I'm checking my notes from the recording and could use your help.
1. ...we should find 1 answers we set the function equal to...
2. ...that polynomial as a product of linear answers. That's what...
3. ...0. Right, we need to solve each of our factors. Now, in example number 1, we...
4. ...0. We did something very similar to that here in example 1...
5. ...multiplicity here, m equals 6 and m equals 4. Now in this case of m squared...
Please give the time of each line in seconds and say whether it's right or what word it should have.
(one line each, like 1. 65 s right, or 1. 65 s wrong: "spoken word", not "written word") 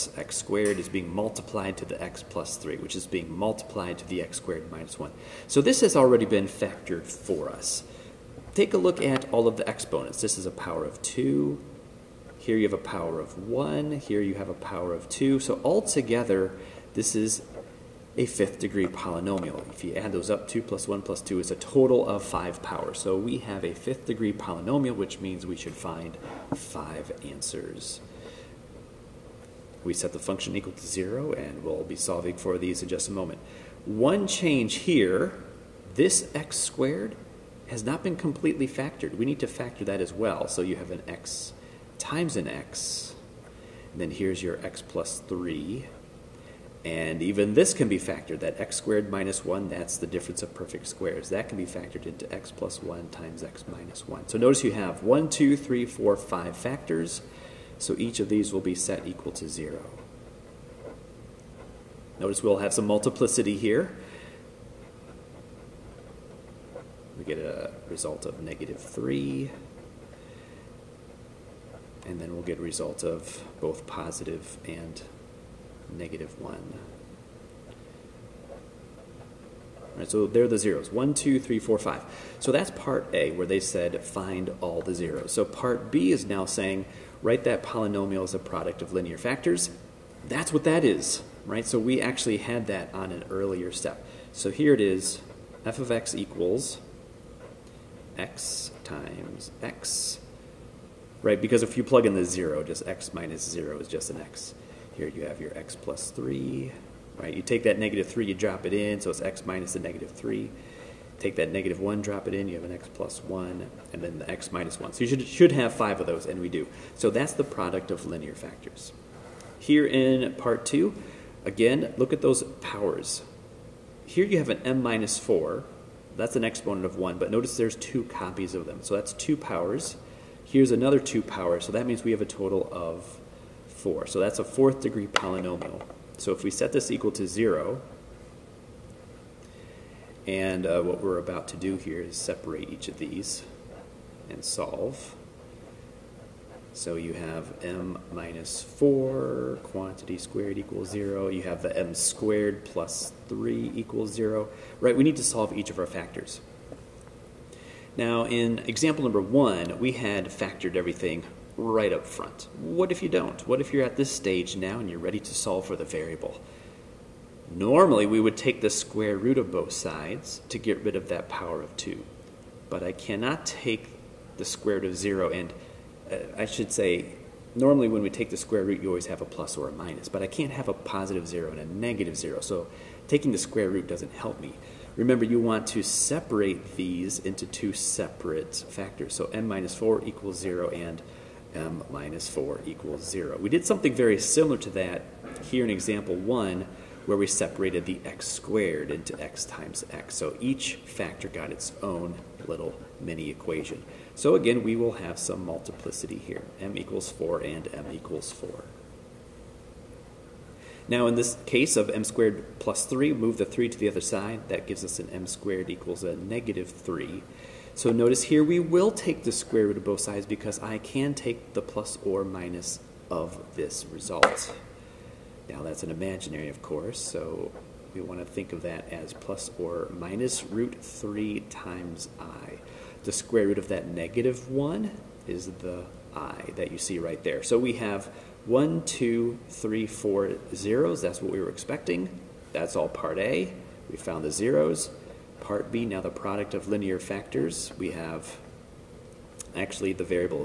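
1. 25 s wrong: "5", not "1"
2. 87 s wrong: "factors", not "answers"
3. 154 s right
4. 193 s right
5. 205 s wrong: "4", not "6".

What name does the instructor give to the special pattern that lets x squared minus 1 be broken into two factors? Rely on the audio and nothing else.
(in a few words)
difference of perfect squares.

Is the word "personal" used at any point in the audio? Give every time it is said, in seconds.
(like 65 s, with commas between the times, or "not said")
not said.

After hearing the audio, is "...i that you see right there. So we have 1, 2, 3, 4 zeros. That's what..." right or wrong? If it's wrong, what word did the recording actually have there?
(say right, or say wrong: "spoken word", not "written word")
right.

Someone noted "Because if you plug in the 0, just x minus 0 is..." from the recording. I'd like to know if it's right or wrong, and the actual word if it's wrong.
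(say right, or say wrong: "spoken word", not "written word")
right.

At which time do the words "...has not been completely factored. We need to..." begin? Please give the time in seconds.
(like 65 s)
37 s.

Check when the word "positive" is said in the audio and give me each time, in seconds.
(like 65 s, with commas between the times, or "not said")
73 s, 180 s.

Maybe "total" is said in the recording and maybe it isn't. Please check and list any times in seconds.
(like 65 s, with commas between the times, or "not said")
21 s, 132 s.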